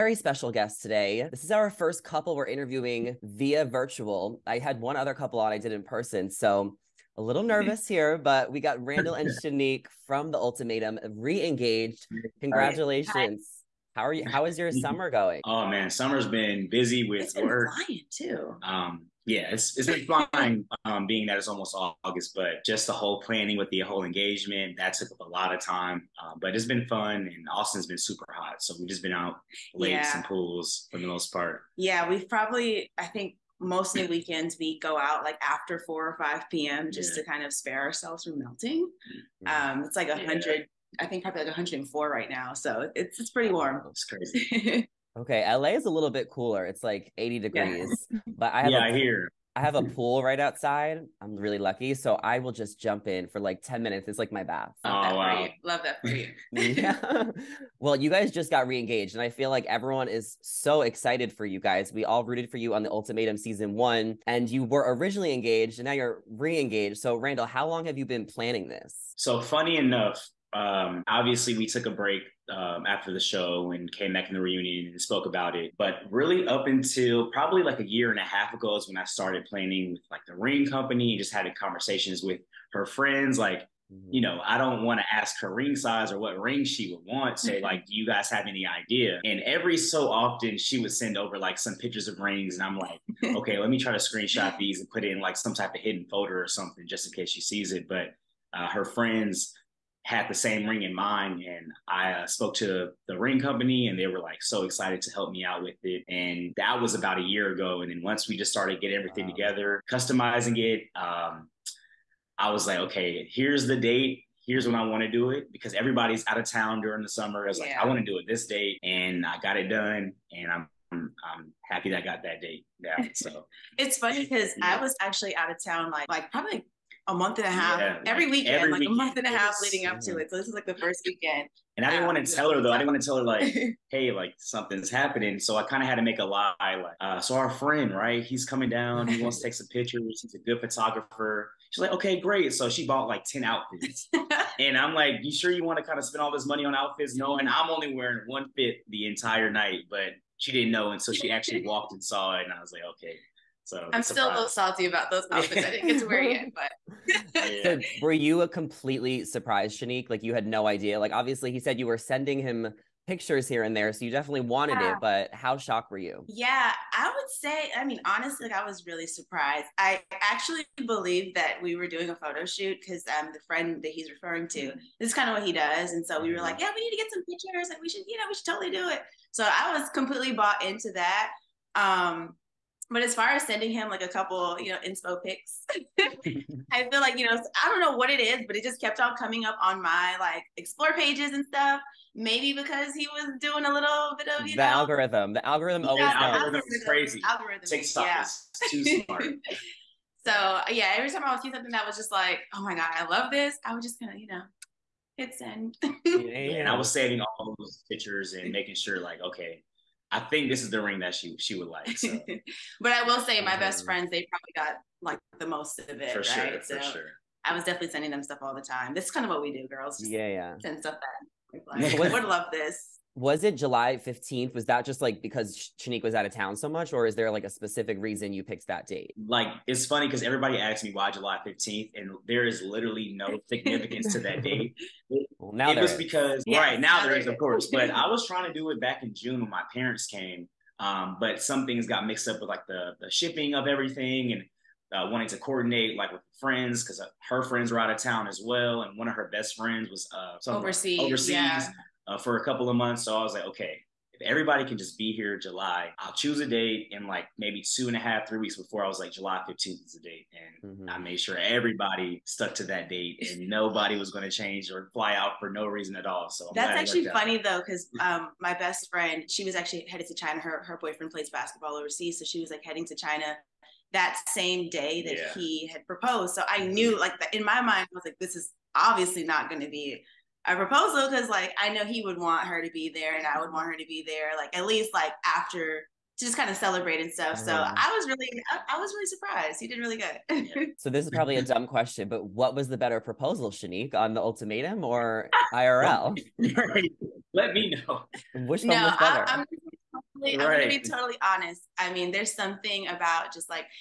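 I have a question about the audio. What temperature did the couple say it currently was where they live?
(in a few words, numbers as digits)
104.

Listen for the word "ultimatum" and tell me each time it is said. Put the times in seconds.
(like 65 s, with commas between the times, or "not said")
10 s, 62 s, 294 s.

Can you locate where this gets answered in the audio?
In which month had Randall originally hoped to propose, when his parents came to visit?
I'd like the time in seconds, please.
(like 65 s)
239 s.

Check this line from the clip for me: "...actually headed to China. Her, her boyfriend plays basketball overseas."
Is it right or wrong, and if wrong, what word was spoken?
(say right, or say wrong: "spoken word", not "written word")
right.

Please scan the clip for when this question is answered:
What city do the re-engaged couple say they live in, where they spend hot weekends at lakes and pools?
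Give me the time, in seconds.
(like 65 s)
27 s.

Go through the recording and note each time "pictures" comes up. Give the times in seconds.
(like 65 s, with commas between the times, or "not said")
91 s, 139 s, 163 s, 177 s, 207 s.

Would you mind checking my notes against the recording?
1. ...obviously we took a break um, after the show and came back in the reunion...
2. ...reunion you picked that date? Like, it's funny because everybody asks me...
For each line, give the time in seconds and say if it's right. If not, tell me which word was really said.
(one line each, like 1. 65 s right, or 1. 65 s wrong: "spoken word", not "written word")
1. 71 s right
2. 227 s wrong: "reason", not "reunion".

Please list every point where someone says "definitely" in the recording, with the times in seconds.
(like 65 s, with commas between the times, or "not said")
164 s, 217 s.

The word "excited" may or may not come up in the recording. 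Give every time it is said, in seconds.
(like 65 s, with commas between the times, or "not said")
60 s, 104 s.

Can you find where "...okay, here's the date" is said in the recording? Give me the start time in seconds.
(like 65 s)
112 s.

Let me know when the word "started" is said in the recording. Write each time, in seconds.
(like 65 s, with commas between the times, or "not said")
79 s, 108 s.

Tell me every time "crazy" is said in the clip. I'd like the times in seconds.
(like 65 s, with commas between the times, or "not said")
44 s, 196 s.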